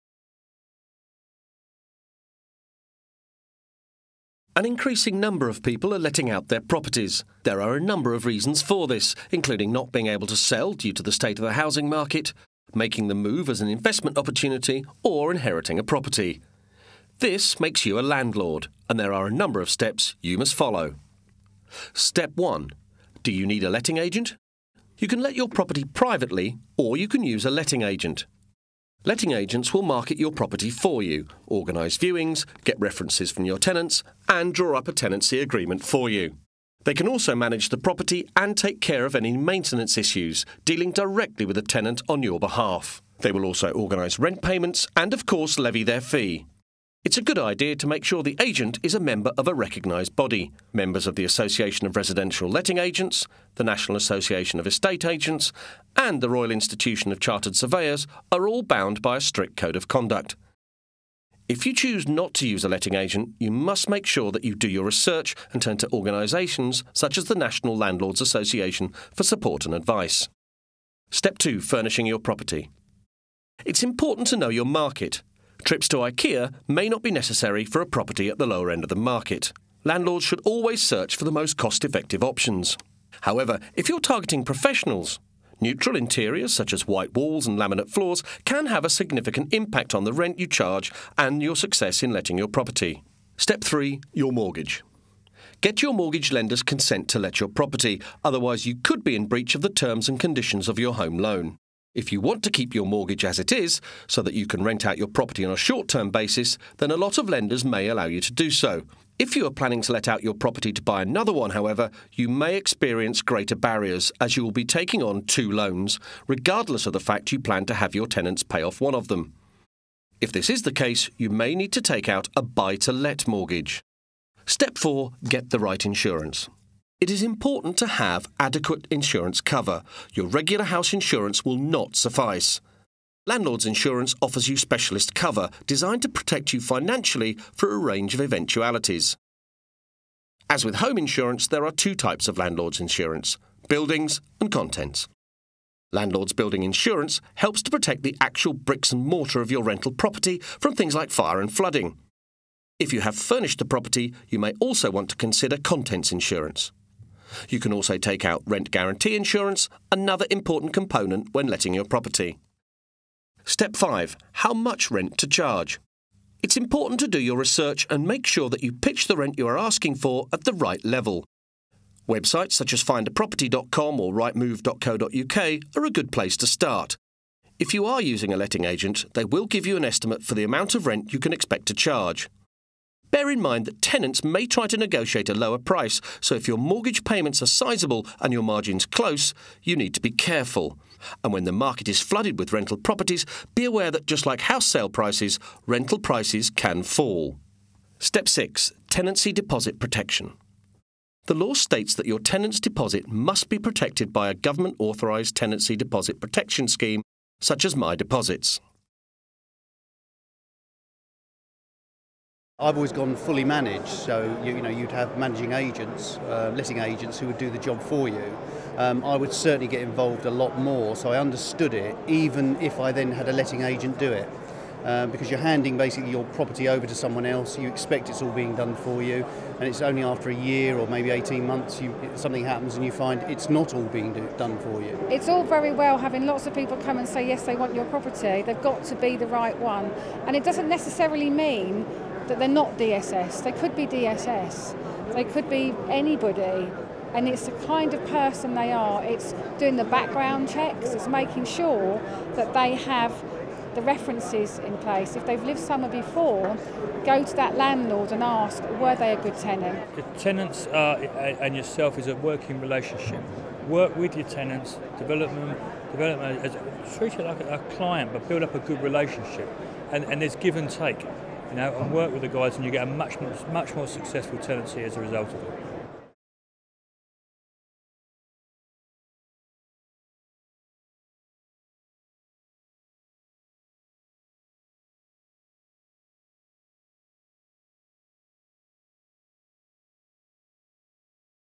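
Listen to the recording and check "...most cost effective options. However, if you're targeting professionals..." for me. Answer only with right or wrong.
right.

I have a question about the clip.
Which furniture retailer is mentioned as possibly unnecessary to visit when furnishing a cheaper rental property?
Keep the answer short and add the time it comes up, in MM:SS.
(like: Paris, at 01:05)
IKEA, at 01:15.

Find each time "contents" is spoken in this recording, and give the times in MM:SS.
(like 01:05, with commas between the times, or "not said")
02:24, 02:35.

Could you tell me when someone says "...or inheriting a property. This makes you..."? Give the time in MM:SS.
00:15.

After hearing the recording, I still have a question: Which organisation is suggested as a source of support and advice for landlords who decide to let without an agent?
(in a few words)
National Landlords Association.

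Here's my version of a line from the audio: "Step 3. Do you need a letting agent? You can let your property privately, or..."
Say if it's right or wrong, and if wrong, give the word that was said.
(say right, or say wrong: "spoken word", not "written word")
wrong: "1", not "3".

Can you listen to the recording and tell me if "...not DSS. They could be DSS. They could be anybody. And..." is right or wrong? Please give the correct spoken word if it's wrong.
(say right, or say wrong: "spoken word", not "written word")
right.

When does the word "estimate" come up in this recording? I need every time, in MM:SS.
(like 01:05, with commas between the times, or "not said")
02:59.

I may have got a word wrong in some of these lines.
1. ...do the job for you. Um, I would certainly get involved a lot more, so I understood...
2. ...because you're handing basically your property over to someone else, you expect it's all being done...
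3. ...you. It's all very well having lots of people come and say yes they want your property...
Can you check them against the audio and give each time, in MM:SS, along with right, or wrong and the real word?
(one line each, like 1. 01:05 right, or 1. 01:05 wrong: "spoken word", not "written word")
1. 03:37 right
2. 03:45 right
3. 03:54 right.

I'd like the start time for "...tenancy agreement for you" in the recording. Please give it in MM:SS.
00:34.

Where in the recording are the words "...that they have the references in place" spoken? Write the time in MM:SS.
04:12.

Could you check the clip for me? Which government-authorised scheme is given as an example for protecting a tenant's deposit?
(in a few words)
My Deposits.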